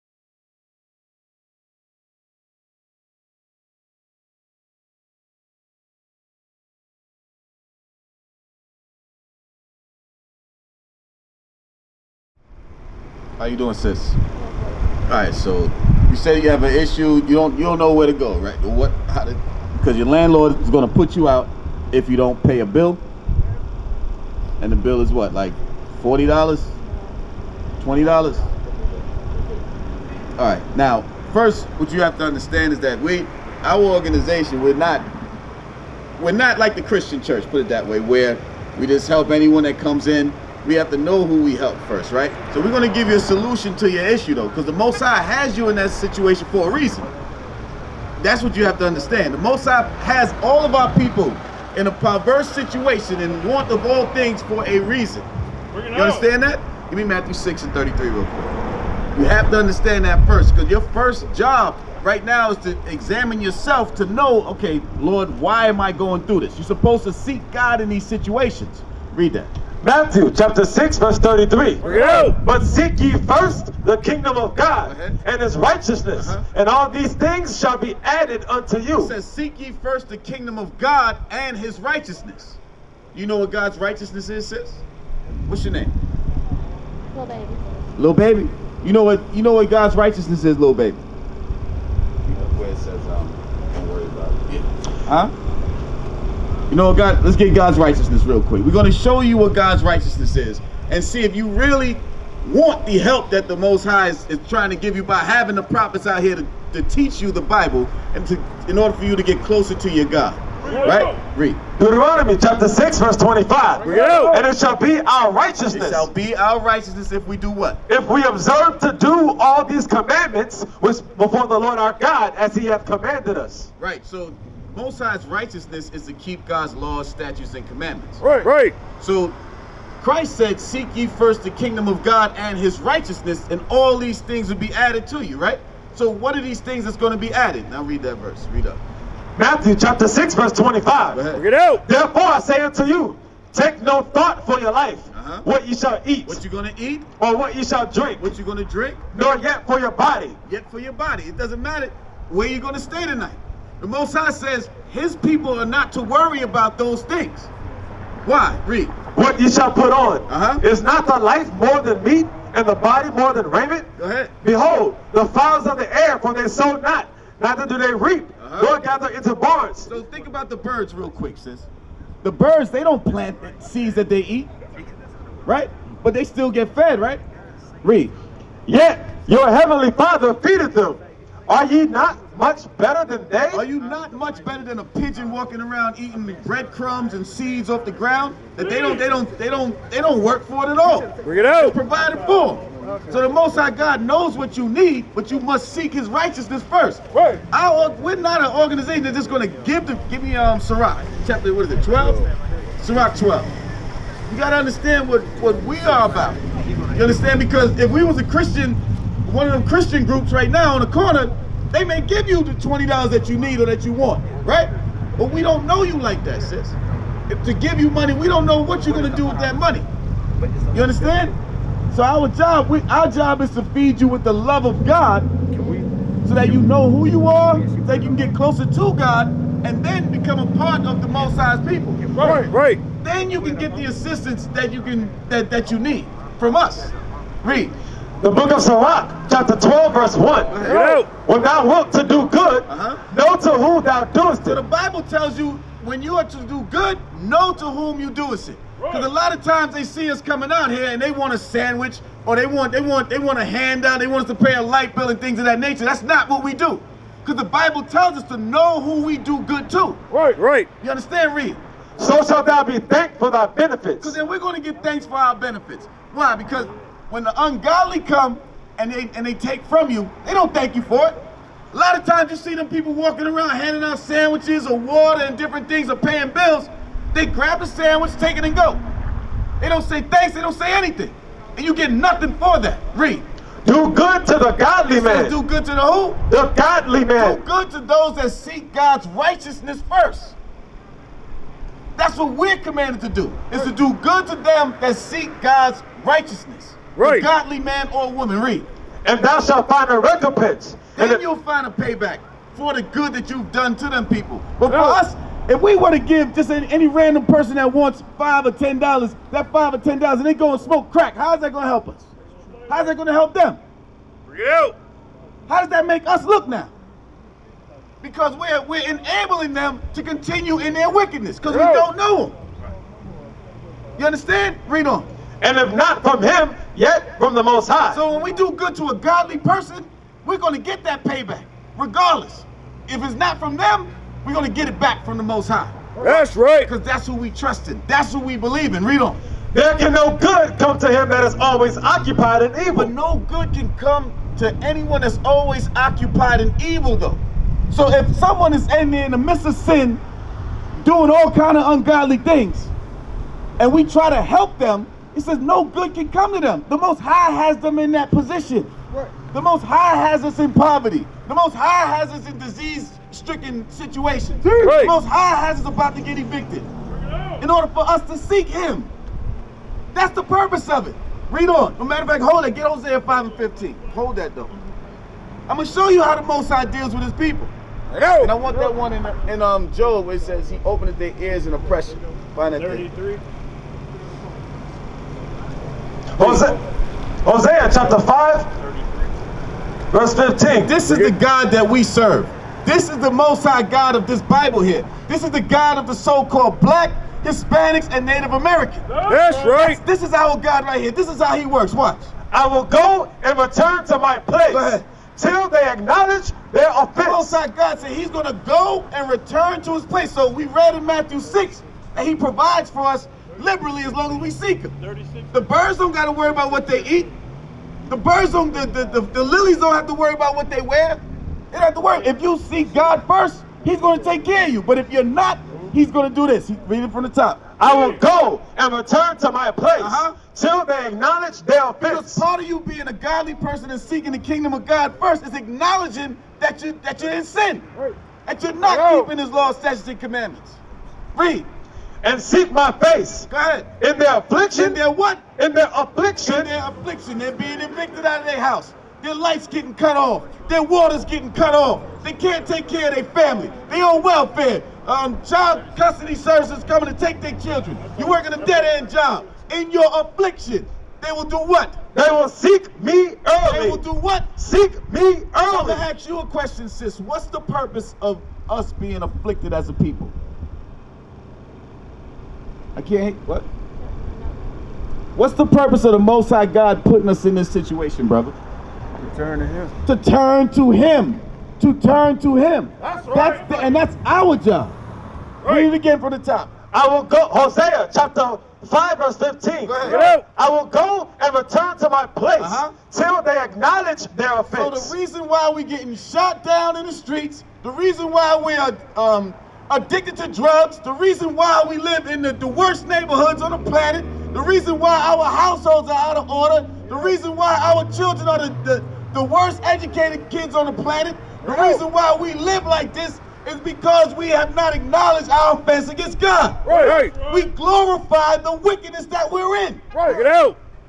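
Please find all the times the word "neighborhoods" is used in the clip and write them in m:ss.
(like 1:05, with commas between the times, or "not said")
8:22.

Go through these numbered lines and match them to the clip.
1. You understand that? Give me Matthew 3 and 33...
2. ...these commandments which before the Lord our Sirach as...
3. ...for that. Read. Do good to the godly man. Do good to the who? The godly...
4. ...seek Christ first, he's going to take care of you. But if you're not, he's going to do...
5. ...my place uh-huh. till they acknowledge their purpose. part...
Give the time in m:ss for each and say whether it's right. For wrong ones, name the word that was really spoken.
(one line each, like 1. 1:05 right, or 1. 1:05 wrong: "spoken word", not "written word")
1. 0:55 wrong: "6", not "3"
2. 1:59 wrong: "God", not "Sirach"
3. 4:42 right
4. 7:02 wrong: "God", not "Christ"
5. 7:09 wrong: "offense", not "purpose".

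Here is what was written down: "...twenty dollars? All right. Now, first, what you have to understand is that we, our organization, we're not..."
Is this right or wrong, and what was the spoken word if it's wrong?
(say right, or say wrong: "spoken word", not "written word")
right.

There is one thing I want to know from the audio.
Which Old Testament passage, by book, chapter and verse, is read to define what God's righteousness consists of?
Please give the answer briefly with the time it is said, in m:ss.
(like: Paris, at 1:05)
Deuteronomy 6:25, at 1:51.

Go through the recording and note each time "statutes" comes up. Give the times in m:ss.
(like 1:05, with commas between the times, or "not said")
2:07, 7:19.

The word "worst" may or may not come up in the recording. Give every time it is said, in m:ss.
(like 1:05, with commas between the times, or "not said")
8:22, 8:29.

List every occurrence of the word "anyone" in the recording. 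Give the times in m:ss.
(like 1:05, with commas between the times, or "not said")
0:39, 5:44.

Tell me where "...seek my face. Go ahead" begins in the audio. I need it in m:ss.
7:22.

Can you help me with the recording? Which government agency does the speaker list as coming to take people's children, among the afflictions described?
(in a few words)
child custody services.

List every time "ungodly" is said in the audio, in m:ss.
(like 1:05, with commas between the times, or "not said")
4:27, 5:51.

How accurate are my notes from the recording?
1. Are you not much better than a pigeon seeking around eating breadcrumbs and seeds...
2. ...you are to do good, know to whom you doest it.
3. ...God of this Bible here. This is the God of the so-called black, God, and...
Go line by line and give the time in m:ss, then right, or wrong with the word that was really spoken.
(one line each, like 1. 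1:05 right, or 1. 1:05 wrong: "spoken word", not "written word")
1. 3:03 wrong: "walking", not "seeking"
2. 4:06 right
3. 6:33 wrong: "Hispanics", not "God".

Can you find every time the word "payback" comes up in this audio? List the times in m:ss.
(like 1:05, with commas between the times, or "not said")
5:01, 5:31.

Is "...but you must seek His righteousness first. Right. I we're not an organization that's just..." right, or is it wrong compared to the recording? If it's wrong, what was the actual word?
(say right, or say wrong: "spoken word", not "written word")
right.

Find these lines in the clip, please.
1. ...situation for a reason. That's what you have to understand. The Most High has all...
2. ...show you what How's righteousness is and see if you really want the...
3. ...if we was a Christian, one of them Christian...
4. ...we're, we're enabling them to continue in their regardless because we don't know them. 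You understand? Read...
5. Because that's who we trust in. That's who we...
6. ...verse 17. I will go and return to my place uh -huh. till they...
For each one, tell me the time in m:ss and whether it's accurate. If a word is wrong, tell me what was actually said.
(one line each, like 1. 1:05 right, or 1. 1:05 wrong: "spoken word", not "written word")
1. 0:45 right
2. 1:38 wrong: "God", not "How"
3. 3:27 right
4. 5:18 wrong: "wickedness", not "regardless"
5. 5:36 right
6. 8:08 wrong: "15", not "17".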